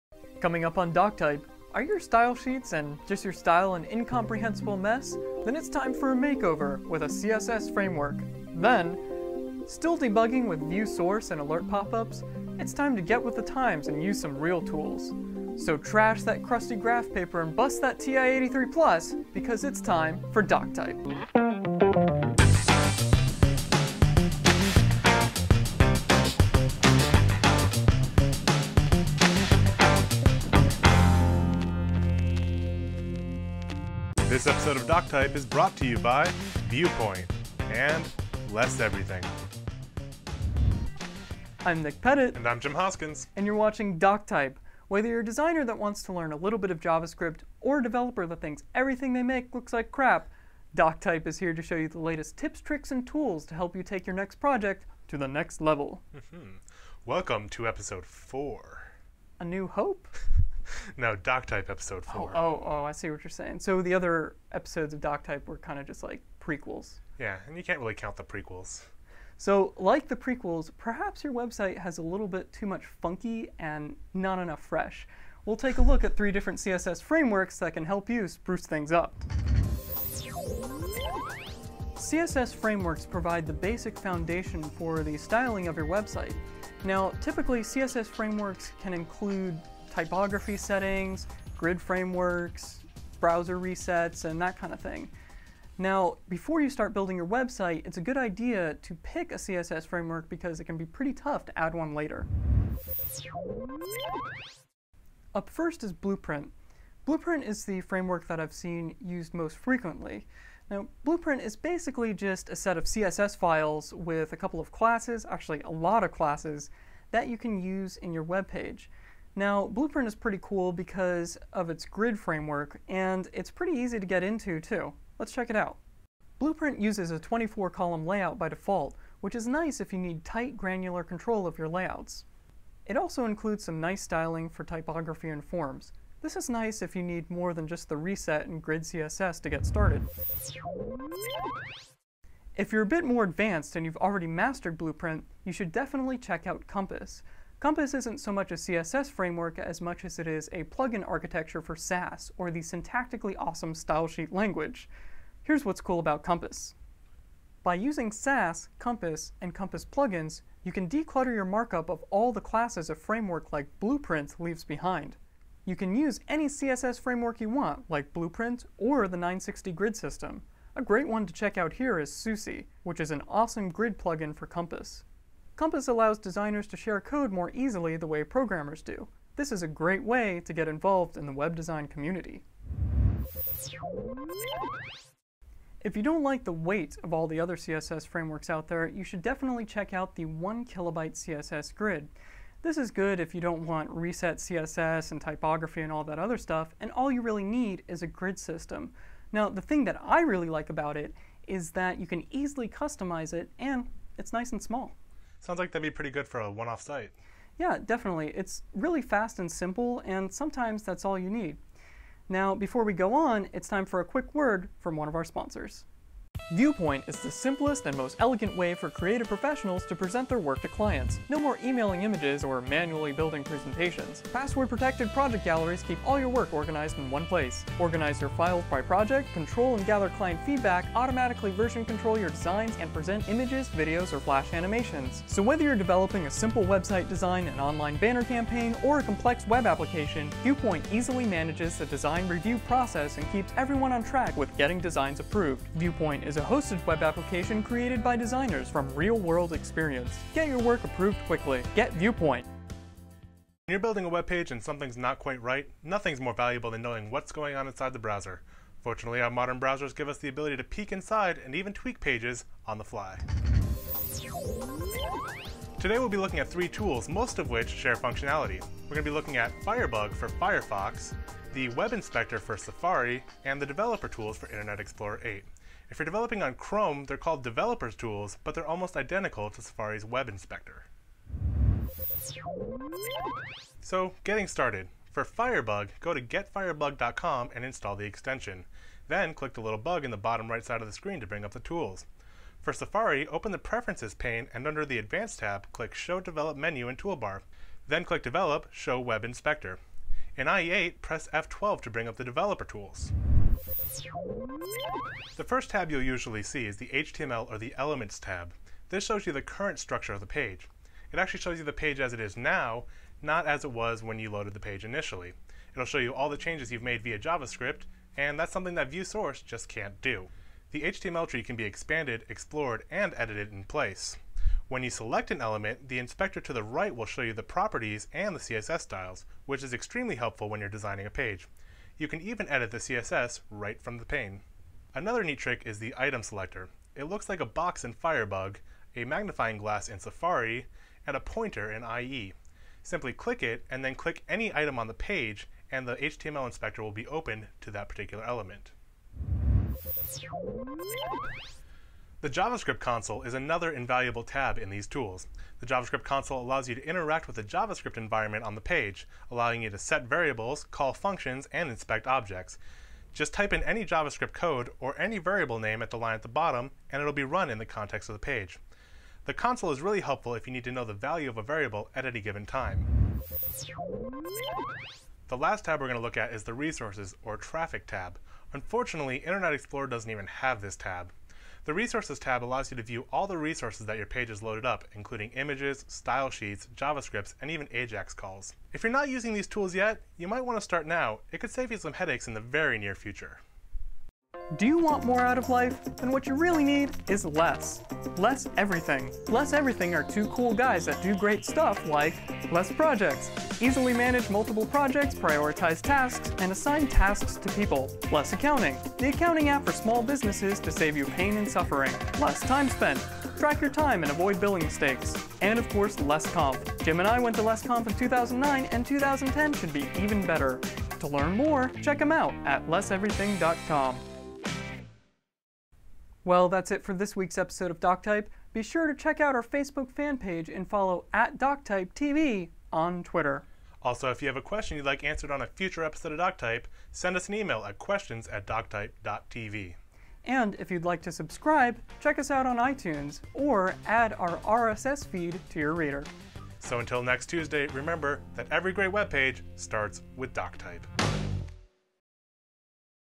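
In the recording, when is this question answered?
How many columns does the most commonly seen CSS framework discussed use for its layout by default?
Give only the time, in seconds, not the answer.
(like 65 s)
127 s.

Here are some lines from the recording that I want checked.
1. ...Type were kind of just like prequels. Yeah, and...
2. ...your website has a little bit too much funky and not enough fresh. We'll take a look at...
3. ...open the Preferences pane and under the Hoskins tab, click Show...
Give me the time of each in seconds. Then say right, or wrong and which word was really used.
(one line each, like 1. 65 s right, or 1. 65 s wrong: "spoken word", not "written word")
1. 65 s right
2. 71 s right
3. 293 s wrong: "Advanced", not "Hoskins".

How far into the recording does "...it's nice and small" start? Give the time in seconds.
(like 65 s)
204 s.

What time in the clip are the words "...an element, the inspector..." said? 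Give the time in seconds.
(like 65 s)
325 s.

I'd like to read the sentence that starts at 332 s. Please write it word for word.
You can even edit the CSS right from the pane.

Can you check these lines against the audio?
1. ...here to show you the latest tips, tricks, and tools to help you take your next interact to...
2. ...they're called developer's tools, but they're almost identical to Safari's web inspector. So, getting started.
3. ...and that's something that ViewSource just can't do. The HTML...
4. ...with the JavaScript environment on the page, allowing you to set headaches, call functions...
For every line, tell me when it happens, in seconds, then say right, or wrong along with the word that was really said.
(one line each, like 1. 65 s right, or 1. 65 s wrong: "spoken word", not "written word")
1. 51 s wrong: "project", not "interact"
2. 277 s right
3. 318 s right
4. 357 s wrong: "variables", not "headaches".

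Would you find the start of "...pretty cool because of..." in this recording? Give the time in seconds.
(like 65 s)
120 s.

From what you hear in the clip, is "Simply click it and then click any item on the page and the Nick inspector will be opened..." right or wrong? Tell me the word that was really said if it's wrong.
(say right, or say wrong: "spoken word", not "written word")
wrong: "HTML", not "Nick".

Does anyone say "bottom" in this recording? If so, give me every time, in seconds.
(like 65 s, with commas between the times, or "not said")
290 s, 366 s.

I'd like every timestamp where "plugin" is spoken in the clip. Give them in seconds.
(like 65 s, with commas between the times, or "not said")
150 s, 159 s, 173 s.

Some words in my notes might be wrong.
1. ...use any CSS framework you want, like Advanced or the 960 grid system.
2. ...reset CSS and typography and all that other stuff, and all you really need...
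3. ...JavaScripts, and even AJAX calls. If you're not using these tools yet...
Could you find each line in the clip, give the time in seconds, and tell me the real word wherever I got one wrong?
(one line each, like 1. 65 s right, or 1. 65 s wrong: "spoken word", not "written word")
1. 165 s wrong: "Blueprint", not "Advanced"
2. 193 s right
3. 386 s right.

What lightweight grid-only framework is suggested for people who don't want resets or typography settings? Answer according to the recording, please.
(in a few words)
1 kilobyte CSS grid.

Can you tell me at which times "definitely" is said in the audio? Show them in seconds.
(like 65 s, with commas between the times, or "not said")
145 s, 189 s, 207 s.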